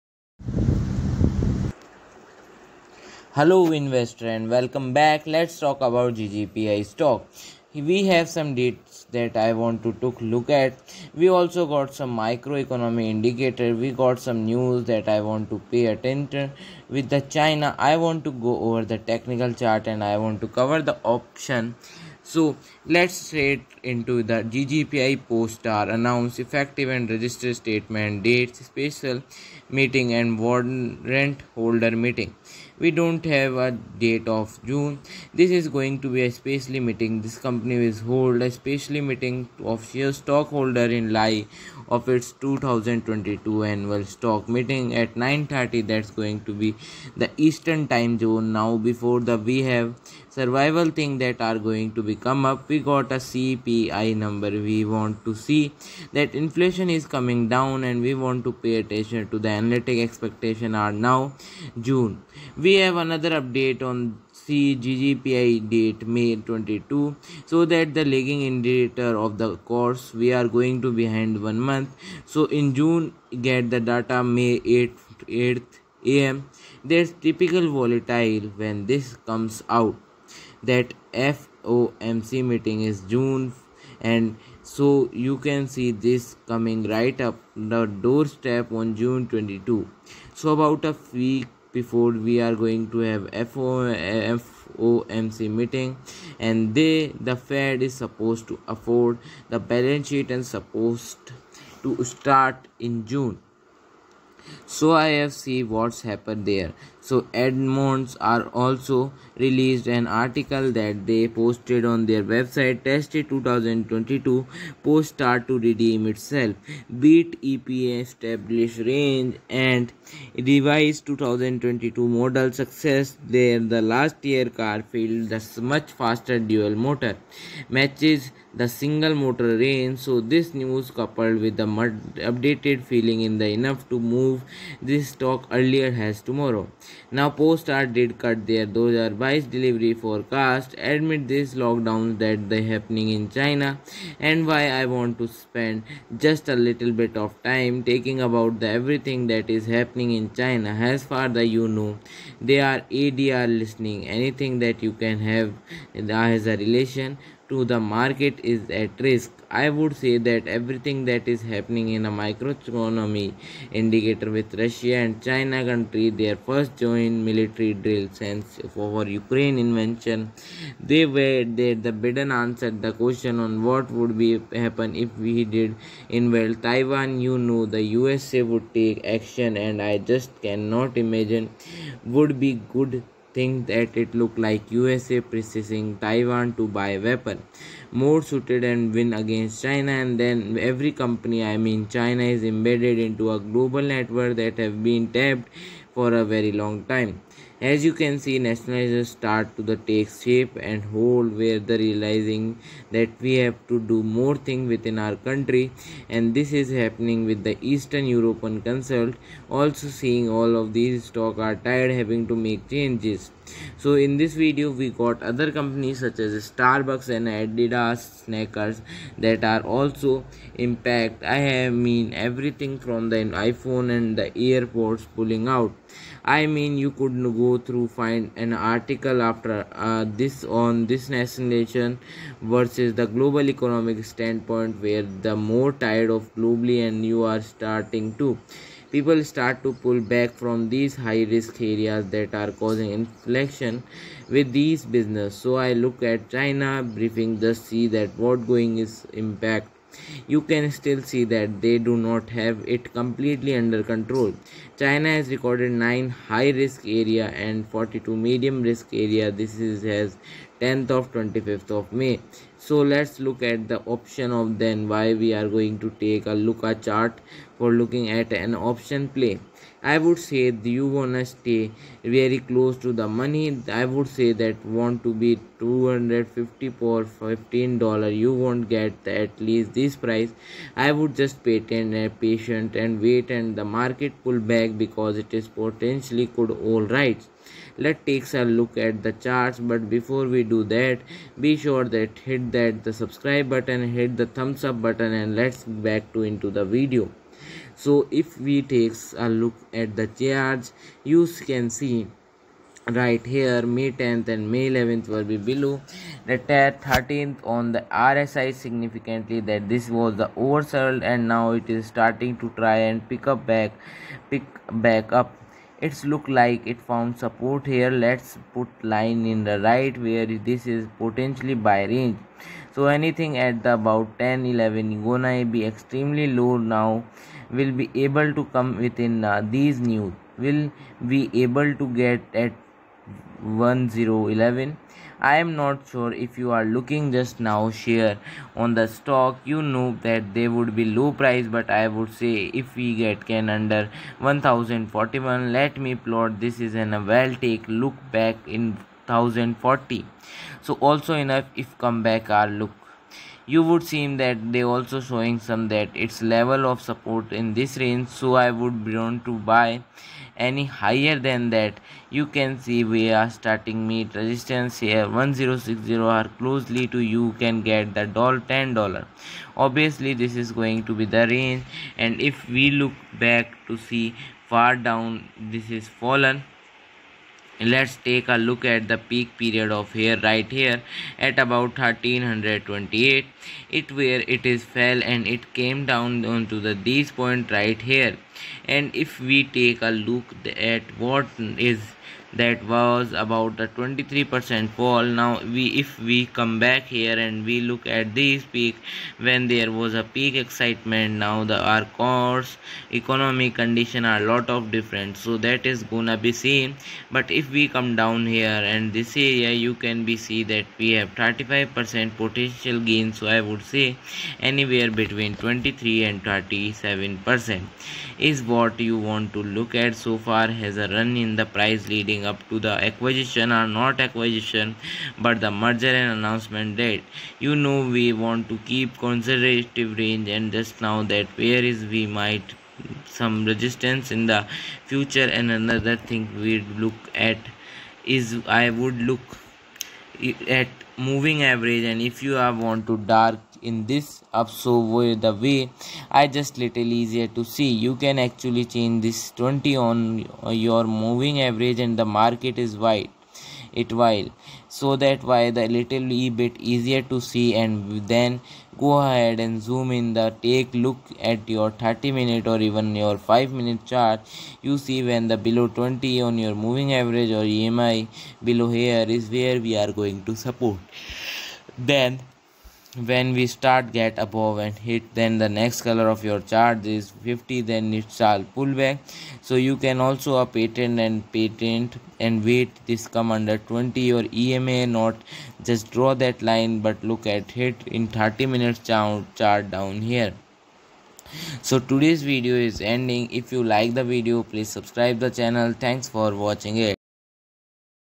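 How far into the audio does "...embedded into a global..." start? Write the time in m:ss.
3:12.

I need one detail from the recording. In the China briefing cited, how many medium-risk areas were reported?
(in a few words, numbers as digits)
42.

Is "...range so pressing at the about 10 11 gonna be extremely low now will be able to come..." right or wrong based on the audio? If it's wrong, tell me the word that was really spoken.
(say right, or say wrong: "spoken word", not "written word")
wrong: "anything", not "pressing".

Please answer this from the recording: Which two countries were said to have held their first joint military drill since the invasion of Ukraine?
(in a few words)
Russia and China.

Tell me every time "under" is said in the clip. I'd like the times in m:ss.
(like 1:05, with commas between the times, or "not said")
4:13, 5:43, 8:03.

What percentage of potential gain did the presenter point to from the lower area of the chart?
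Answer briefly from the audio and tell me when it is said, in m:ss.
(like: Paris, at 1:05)
35%, at 6:51.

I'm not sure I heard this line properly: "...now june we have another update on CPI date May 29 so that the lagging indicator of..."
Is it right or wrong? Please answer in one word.
wrong.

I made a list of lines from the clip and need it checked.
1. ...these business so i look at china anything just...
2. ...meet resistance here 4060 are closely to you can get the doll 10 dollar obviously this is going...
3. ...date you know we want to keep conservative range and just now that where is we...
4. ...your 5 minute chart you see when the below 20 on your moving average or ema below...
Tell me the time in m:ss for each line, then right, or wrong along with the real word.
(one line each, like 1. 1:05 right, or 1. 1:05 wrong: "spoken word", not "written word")
1. 4:04 wrong: "briefing", not "anything"
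2. 6:03 wrong: "1060", not "4060"
3. 7:06 right
4. 7:42 right.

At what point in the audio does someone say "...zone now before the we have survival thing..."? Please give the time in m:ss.
0:48.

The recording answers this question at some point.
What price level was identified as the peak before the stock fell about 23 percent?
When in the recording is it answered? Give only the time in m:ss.
6:21.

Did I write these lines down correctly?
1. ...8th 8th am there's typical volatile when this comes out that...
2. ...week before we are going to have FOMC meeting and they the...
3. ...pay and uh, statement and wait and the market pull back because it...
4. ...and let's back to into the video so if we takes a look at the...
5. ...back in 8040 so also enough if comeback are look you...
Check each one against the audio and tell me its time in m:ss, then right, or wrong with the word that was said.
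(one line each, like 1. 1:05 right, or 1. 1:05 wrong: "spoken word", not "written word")
1. 1:14 right
2. 1:31 right
3. 4:41 wrong: "patient", not "statement"
4. 4:55 right
5. 5:48 wrong: "1040", not "8040".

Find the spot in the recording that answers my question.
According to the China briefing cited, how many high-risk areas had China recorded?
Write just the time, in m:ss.
4:15.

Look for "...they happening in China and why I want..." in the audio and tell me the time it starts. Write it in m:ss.
2:22.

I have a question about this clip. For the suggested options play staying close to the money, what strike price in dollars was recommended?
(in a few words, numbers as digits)
$15.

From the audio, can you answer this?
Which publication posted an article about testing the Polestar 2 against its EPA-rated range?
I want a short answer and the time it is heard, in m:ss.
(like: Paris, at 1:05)
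Edmunds, at 1:47.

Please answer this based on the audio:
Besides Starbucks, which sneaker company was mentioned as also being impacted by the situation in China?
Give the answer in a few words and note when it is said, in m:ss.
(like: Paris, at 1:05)
Adidas, at 3:37.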